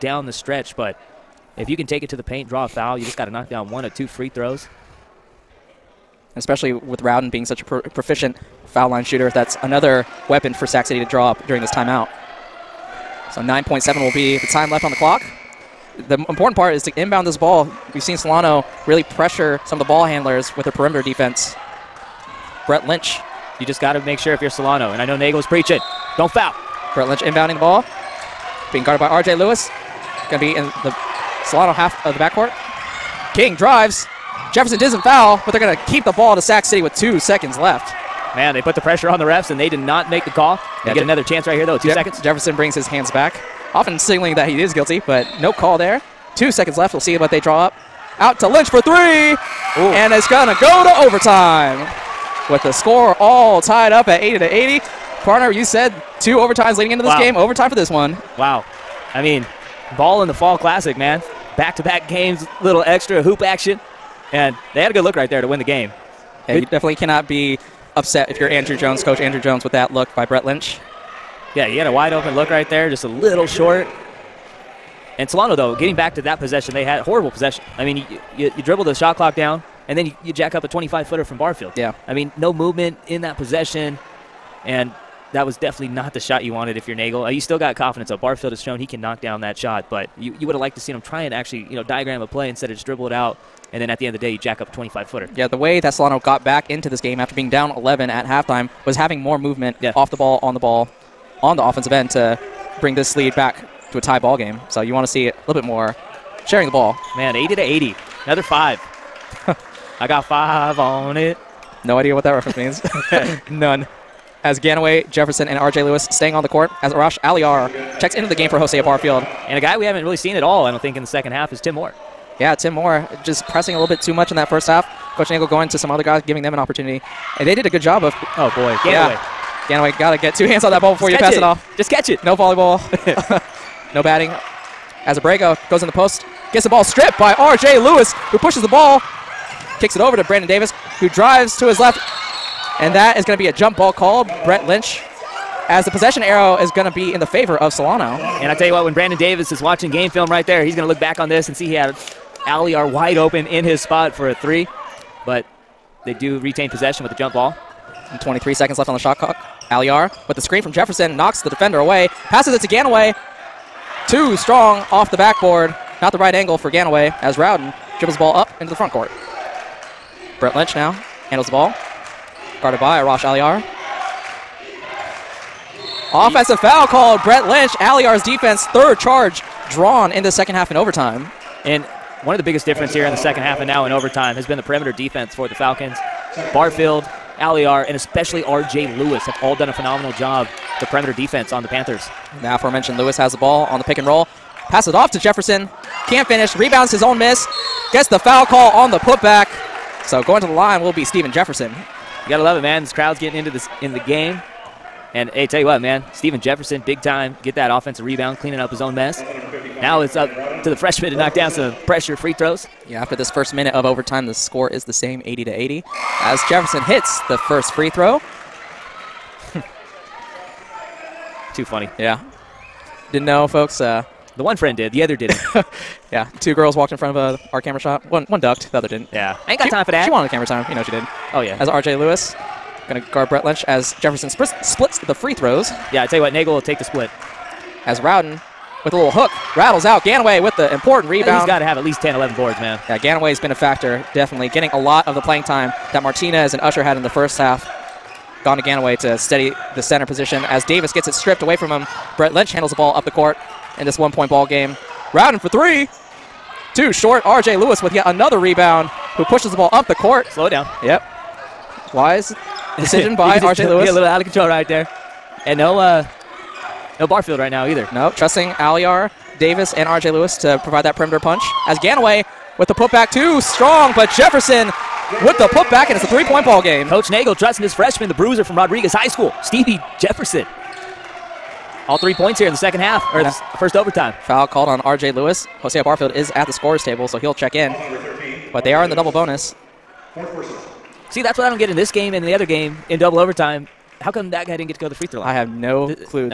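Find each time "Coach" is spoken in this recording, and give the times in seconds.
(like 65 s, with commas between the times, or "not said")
69 s, 125 s, 276 s.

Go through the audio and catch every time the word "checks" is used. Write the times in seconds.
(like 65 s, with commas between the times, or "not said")
117 s, 287 s.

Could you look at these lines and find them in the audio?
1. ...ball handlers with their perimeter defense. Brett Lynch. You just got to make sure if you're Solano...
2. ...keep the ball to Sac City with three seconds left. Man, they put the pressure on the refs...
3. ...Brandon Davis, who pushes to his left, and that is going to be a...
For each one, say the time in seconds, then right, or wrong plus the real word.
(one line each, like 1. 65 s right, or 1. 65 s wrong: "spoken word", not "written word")
1. 19 s right
2. 35 s wrong: "two", not "three"
3. 140 s wrong: "drives", not "pushes".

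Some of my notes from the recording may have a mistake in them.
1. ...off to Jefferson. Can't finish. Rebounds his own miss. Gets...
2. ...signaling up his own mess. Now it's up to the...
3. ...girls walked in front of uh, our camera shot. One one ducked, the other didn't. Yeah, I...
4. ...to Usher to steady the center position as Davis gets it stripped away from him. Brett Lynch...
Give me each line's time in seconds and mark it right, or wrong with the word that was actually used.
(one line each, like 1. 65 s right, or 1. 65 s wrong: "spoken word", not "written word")
1. 194 s right
2. 208 s wrong: "cleaning", not "signaling"
3. 226 s right
4. 248 s wrong: "Ganaway", not "Usher".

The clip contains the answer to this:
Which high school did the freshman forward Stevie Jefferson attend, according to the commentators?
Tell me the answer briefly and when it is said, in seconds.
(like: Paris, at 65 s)
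Rodriguez High School, at 278 s.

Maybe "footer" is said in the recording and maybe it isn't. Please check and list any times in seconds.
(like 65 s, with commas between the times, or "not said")
81 s, 95 s.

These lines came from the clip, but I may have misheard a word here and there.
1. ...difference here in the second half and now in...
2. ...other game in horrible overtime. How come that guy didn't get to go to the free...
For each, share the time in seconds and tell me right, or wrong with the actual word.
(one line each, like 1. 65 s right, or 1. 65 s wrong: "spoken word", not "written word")
1. 182 s right
2. 292 s wrong: "double", not "horrible".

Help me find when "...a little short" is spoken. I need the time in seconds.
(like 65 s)
73 s.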